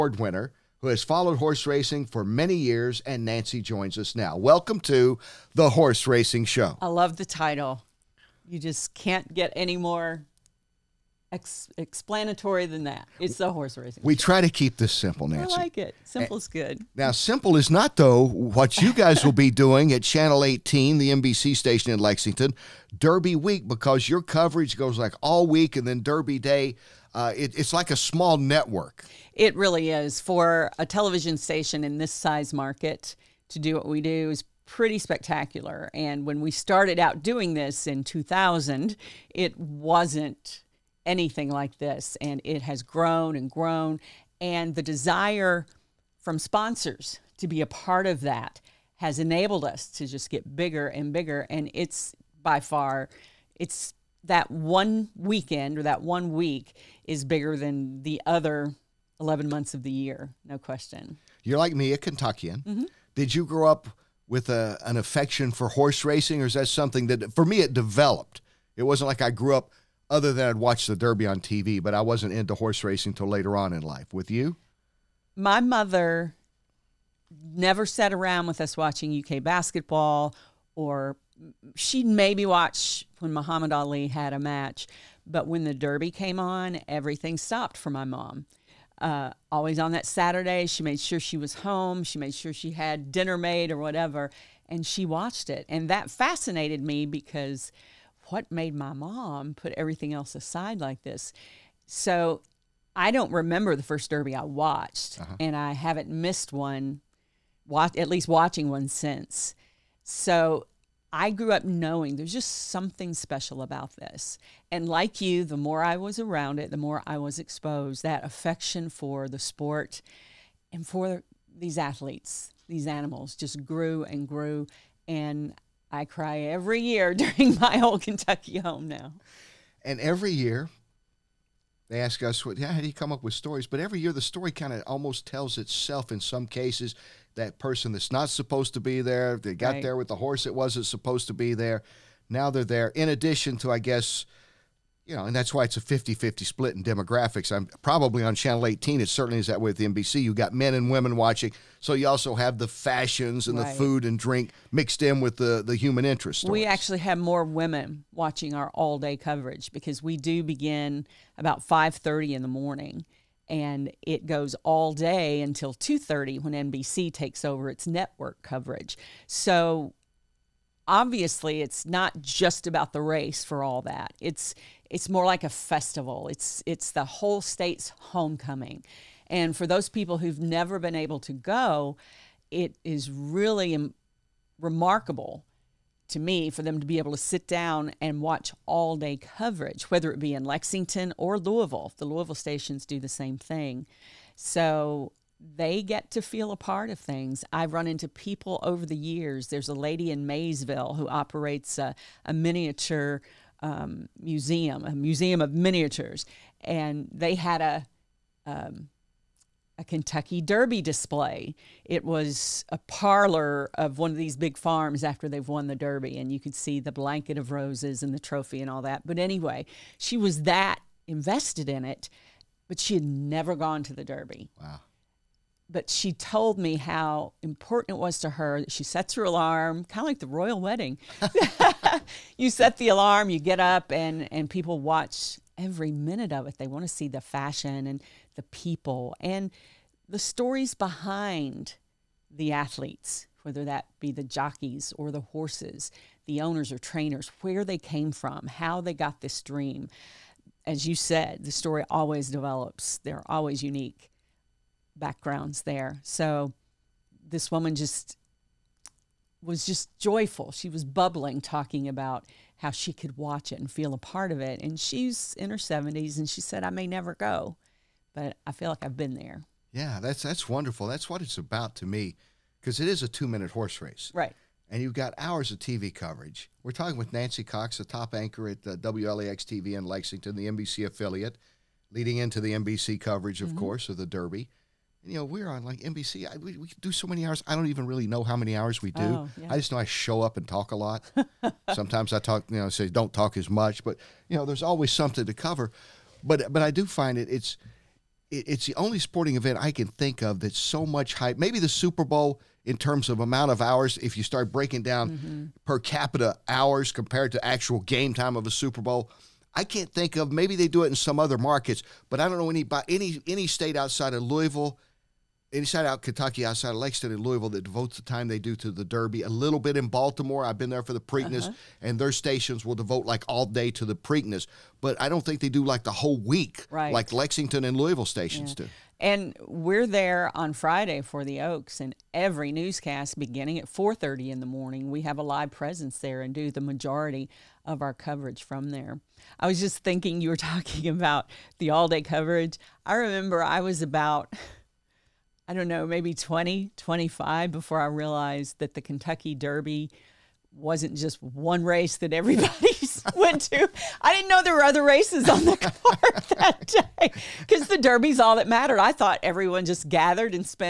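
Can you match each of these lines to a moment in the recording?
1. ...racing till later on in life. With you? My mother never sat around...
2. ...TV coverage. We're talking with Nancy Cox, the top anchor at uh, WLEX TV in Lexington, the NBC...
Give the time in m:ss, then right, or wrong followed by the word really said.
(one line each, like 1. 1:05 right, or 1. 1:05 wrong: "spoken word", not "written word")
1. 1:12 right
2. 4:35 right.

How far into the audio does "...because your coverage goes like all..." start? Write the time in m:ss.
0:23.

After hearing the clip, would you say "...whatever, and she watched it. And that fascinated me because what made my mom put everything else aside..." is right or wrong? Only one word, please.
right.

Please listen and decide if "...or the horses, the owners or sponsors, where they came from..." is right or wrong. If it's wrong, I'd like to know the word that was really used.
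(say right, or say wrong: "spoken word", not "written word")
wrong: "trainers", not "sponsors".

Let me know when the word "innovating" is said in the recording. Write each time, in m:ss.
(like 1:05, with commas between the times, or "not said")
not said.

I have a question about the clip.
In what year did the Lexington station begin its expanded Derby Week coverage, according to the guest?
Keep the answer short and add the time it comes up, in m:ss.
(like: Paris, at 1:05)
2000, at 0:38.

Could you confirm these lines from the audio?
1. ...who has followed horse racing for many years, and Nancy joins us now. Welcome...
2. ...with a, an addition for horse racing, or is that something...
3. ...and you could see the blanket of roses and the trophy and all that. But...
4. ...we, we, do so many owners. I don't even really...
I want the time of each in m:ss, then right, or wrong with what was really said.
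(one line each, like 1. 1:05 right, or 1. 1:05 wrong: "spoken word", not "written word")
1. 0:00 right
2. 1:04 wrong: "affection", not "addition"
3. 3:36 right
4. 4:46 wrong: "hours", not "owners".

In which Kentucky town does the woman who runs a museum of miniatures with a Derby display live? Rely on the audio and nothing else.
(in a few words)
Maysville.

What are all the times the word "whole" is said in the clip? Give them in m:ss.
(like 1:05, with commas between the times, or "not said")
2:57, 5:25.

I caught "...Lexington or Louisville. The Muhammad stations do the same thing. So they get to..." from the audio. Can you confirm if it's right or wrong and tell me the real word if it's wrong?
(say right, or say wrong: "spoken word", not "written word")
wrong: "Louisville", not "Muhammad".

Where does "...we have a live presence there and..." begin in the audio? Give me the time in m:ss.
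5:34.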